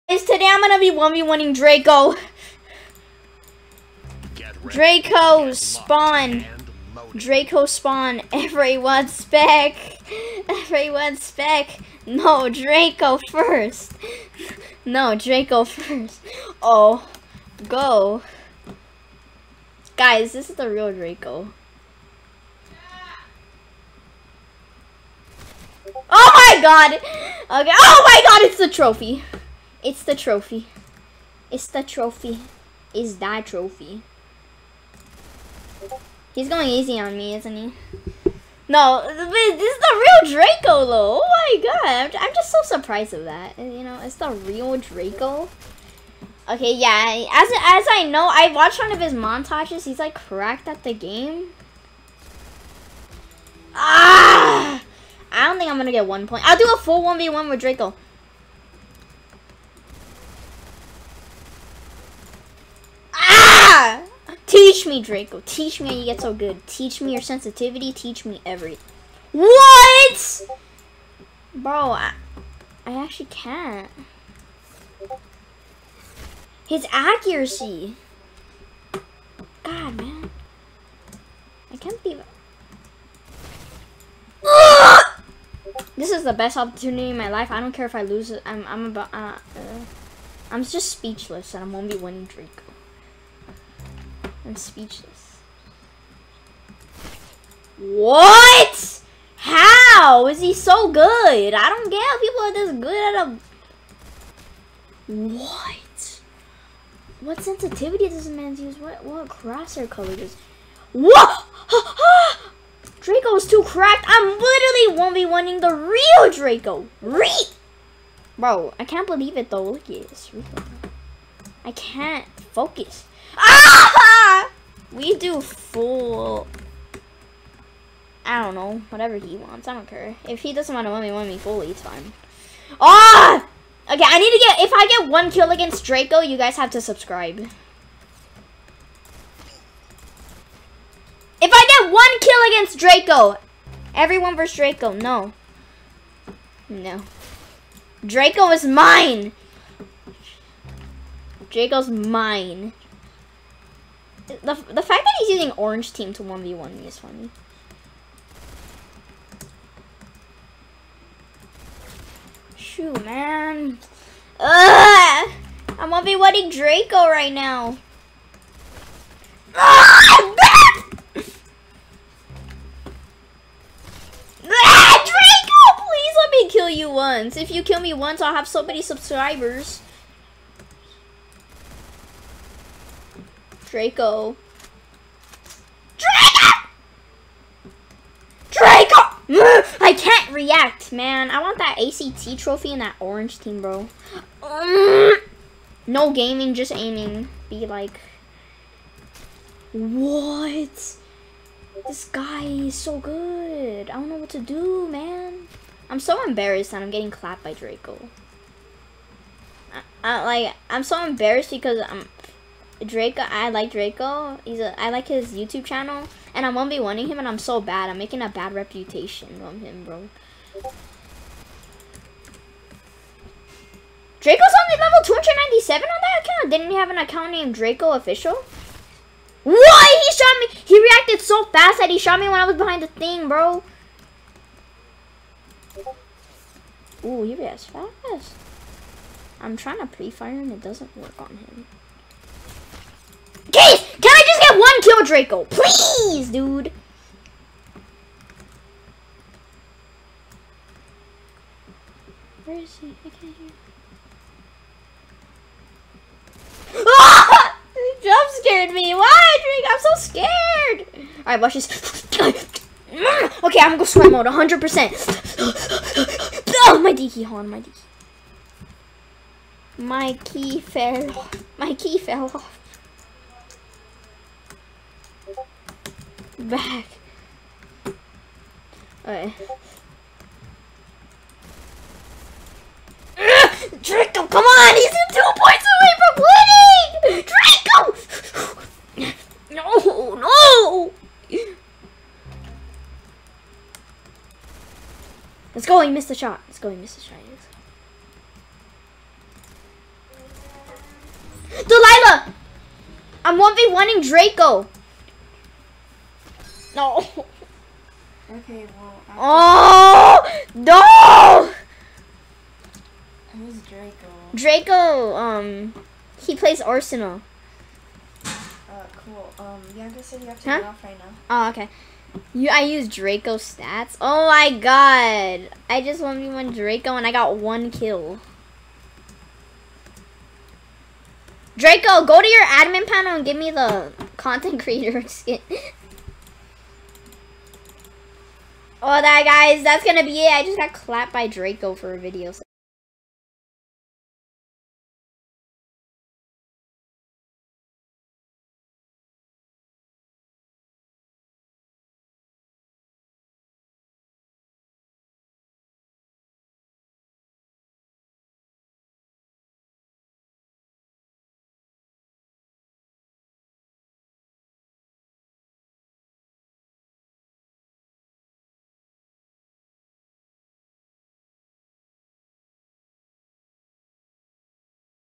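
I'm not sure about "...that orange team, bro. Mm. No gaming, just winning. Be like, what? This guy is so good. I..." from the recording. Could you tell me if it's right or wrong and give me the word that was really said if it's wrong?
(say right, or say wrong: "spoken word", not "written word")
wrong: "aiming", not "winning".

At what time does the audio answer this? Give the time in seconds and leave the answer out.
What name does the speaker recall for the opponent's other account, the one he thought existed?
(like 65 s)
227 s.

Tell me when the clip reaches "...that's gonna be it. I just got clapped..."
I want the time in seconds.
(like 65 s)
339 s.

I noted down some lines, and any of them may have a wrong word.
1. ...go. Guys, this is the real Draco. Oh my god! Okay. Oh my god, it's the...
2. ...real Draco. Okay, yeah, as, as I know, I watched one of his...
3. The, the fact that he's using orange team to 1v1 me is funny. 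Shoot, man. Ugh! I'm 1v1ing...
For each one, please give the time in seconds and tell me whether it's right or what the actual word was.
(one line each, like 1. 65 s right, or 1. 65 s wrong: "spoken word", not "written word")
1. 17 s right
2. 44 s right
3. 154 s right.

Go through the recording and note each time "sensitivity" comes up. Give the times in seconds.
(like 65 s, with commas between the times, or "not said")
67 s, 107 s.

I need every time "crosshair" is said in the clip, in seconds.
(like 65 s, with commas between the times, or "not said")
109 s.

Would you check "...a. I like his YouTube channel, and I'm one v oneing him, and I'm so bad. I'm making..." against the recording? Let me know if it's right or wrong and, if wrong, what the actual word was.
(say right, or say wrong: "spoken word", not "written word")
right.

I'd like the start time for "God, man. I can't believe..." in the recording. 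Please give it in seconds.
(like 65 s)
79 s.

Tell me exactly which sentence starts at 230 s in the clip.
He reacted so fast that he shot me when I was behind the thing, bro.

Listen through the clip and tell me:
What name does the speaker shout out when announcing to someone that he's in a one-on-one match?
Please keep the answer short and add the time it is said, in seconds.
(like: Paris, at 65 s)
Delilah, at 301 s.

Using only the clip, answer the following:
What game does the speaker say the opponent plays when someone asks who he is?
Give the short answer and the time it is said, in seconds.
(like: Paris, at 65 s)
Arsenal, at 316 s.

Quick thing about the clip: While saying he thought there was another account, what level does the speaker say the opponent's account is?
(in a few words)
297.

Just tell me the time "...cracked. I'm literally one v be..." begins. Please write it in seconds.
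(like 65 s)
113 s.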